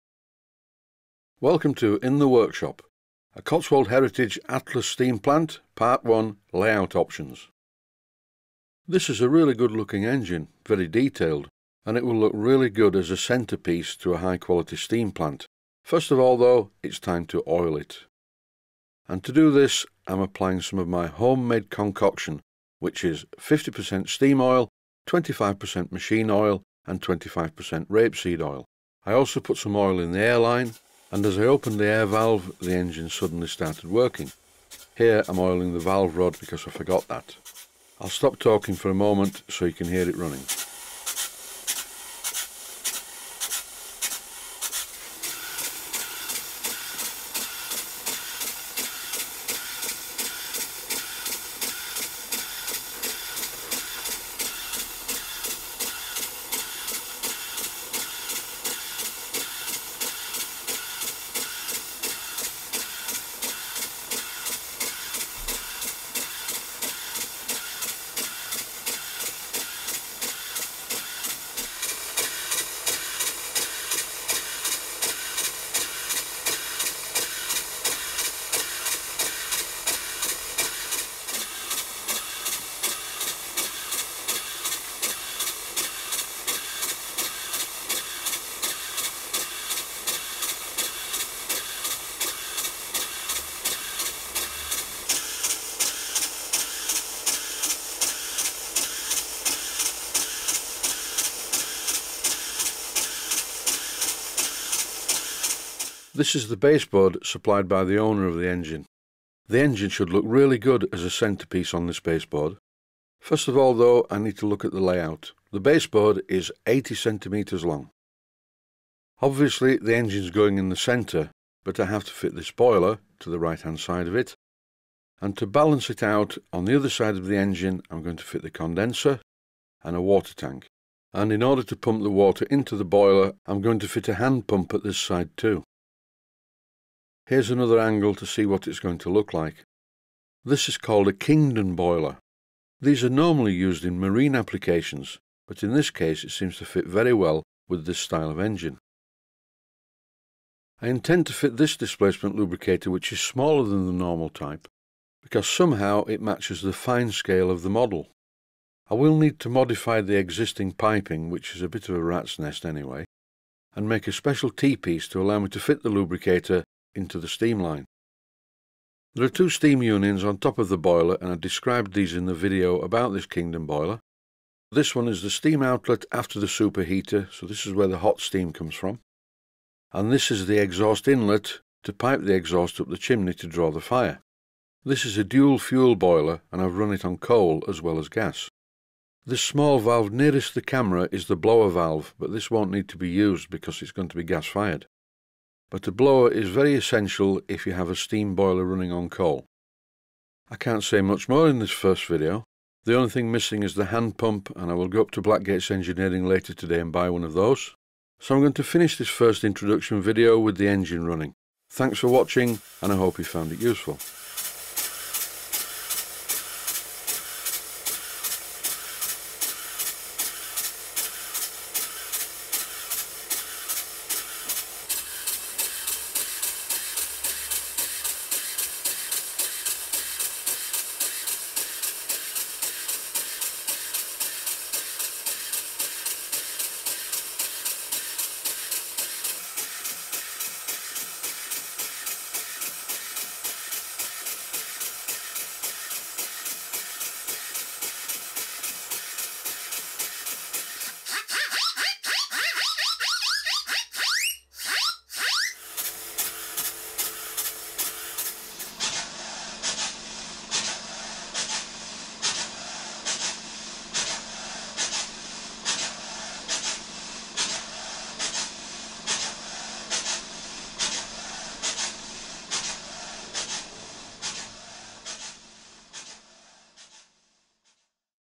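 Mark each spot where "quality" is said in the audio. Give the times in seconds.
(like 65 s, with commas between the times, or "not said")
14 s.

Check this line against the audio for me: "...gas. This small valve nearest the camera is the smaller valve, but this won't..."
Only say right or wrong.
wrong.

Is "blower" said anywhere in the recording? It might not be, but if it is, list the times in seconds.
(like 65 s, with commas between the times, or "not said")
191 s, 195 s.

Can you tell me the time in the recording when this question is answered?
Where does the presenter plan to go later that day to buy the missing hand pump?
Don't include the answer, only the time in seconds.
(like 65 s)
205 s.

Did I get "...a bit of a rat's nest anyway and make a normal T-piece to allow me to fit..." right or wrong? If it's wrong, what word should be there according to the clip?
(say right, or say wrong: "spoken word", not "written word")
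wrong: "special", not "normal".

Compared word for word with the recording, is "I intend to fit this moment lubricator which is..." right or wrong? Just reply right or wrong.
wrong.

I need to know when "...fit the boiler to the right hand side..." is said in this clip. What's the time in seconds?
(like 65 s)
122 s.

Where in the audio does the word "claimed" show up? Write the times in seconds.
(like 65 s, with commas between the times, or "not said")
not said.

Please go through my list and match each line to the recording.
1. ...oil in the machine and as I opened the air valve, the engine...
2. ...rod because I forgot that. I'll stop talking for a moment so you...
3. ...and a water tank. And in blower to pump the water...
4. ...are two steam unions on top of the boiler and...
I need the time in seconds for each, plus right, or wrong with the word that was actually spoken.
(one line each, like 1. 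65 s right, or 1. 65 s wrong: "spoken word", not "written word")
1. 29 s wrong: "airline", not "machine"
2. 36 s right
3. 129 s wrong: "order", not "blower"
4. 169 s right.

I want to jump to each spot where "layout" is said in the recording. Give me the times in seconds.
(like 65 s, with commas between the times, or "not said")
6 s, 114 s.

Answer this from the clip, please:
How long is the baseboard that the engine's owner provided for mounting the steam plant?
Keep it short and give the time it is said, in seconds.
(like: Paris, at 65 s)
80 centimeters, at 116 s.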